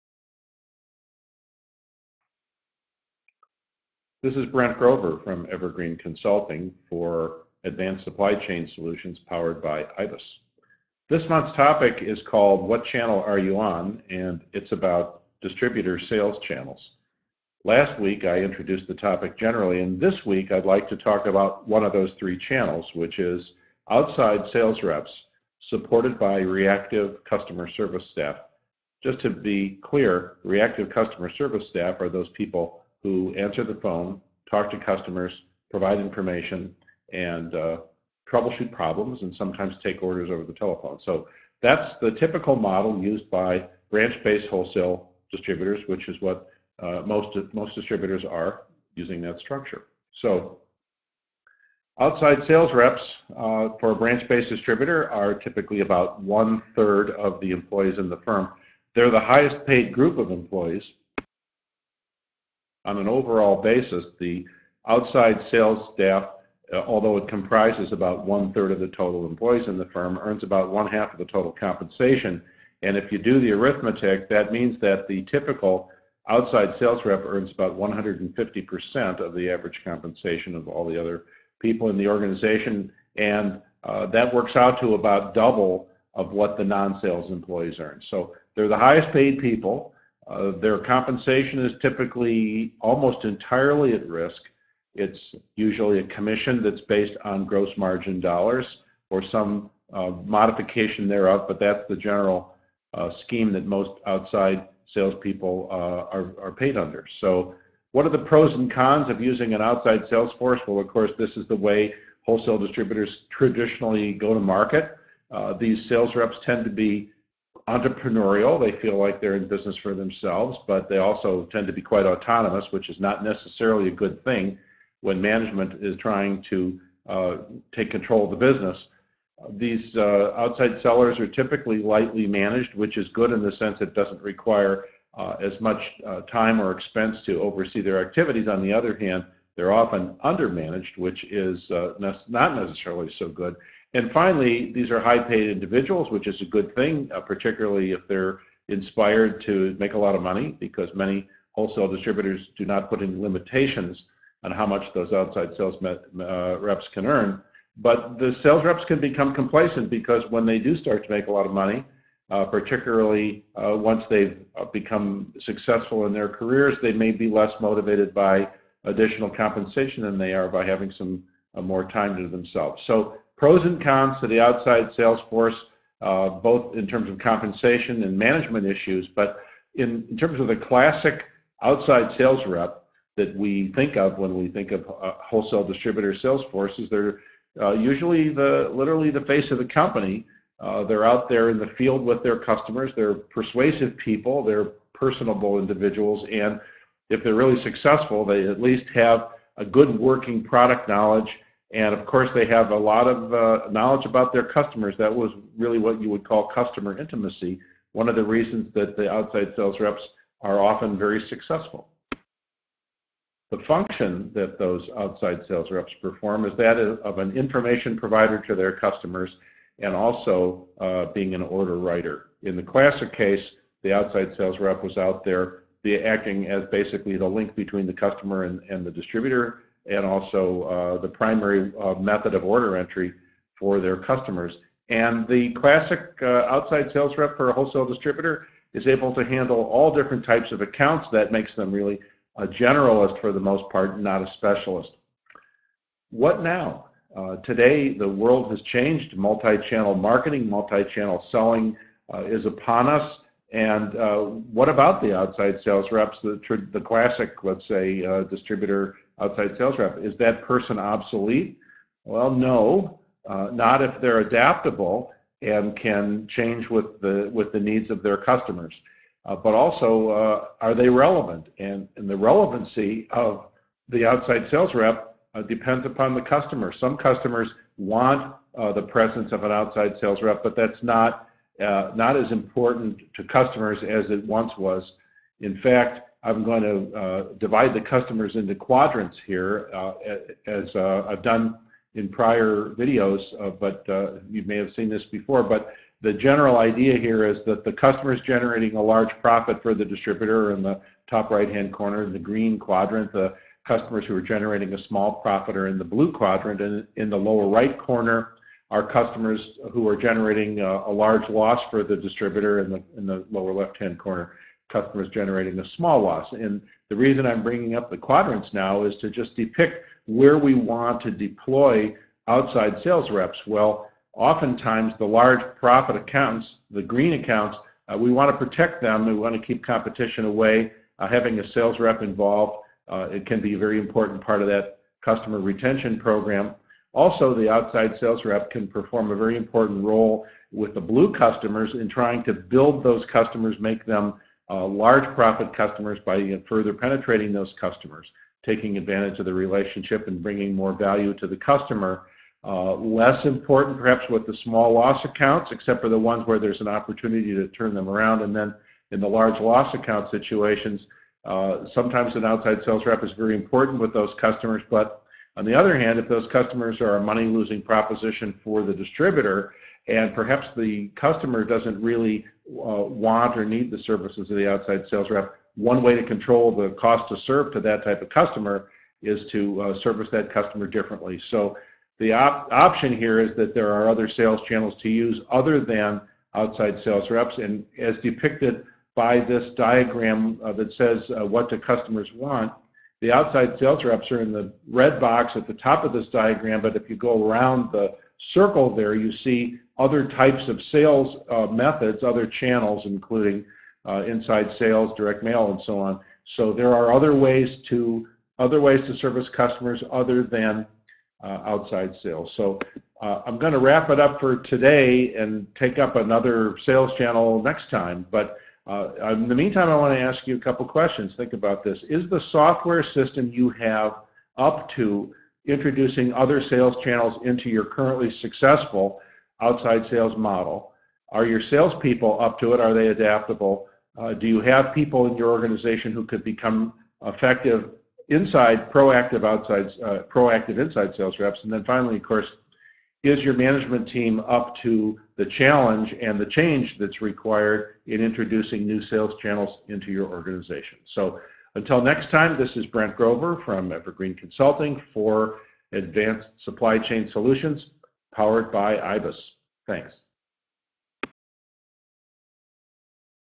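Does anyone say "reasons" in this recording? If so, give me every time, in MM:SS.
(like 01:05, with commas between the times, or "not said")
03:28, 05:16.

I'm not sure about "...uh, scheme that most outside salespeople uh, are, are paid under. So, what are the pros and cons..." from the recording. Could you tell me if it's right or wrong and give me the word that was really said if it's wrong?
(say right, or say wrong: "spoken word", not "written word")
right.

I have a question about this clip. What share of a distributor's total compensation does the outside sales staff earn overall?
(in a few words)
one-half.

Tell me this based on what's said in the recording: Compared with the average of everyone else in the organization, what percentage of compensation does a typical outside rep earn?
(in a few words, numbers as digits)
150%.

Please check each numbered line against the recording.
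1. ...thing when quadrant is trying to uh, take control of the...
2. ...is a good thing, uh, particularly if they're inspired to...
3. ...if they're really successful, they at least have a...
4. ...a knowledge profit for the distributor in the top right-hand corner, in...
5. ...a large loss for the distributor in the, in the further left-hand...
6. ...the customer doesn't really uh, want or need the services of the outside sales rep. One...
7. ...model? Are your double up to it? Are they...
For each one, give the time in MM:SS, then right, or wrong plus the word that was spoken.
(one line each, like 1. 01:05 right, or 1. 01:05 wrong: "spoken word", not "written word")
1. 02:04 wrong: "management", not "quadrant"
2. 02:26 right
3. 03:17 right
4. 04:58 wrong: "large", not "knowledge"
5. 05:10 wrong: "lower", not "further"
6. 06:10 right
7. 07:10 wrong: "salespeople", not "double".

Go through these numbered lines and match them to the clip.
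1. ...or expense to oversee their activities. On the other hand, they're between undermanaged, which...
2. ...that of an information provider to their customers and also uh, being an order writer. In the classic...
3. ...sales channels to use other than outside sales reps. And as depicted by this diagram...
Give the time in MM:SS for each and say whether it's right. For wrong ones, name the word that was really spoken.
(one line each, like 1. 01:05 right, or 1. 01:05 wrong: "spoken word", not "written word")
1. 02:16 wrong: "often", not "between"
2. 03:36 right
3. 06:24 right.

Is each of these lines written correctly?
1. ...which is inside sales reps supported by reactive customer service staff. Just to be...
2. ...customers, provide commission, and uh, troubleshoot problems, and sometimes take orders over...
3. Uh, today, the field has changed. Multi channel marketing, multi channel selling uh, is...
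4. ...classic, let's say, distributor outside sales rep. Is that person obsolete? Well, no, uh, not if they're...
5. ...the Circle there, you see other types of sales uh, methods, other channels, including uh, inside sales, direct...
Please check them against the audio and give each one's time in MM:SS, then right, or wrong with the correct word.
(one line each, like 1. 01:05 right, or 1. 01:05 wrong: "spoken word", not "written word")
1. 00:22 wrong: "outside", not "inside"
2. 00:34 wrong: "information", not "commission"
3. 04:07 wrong: "world", not "field"
4. 04:16 right
5. 06:37 right.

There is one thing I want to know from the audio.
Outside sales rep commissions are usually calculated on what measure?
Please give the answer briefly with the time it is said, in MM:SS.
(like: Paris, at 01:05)
gross margin dollars, at 01:37.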